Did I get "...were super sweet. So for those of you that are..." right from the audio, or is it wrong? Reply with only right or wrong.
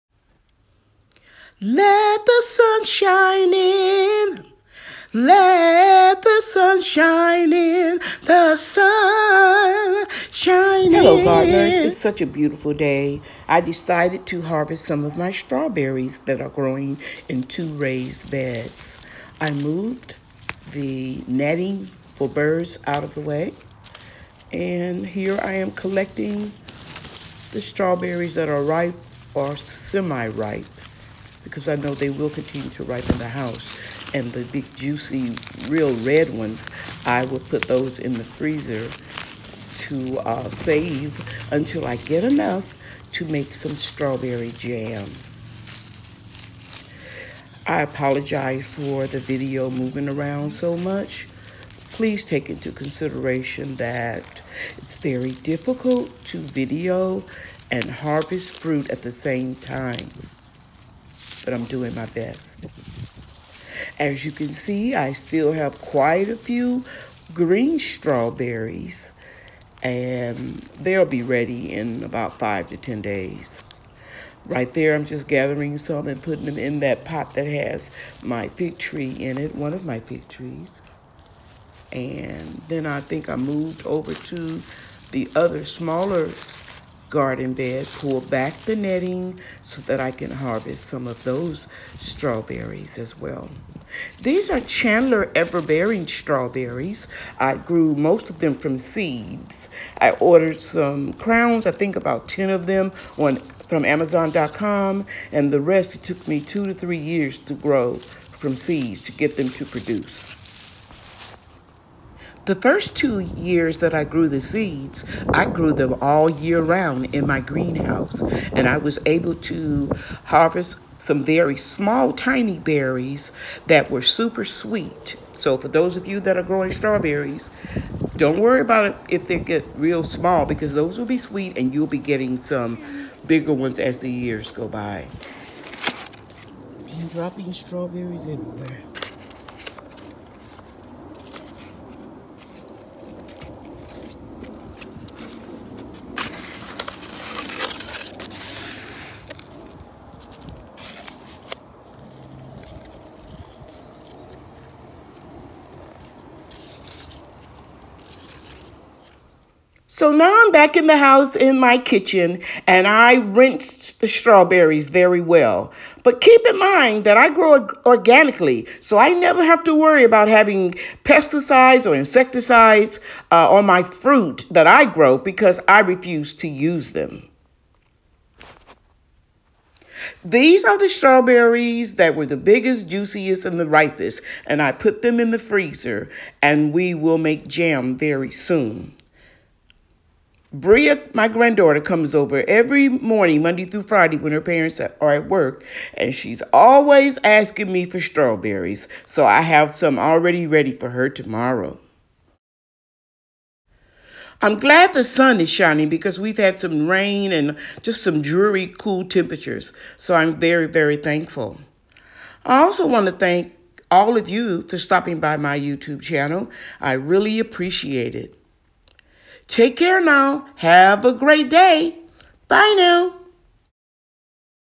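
right.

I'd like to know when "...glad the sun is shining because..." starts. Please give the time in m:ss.
3:24.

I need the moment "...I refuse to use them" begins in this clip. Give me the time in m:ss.
2:55.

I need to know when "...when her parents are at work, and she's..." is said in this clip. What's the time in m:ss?
3:14.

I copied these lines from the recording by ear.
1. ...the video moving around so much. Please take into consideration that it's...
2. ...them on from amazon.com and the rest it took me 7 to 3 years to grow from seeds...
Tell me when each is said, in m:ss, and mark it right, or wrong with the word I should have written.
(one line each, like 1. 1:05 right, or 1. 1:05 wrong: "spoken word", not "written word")
1. 0:49 right
2. 1:42 wrong: "2", not "7".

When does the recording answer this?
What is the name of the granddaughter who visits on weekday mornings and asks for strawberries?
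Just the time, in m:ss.
3:10.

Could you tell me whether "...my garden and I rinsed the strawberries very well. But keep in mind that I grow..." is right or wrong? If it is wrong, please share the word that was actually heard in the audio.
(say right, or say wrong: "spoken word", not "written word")
wrong: "kitchen", not "garden".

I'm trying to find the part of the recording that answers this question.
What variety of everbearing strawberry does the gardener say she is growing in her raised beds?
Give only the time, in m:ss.
1:34.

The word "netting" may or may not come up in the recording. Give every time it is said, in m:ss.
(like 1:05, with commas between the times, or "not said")
0:21, 1:28.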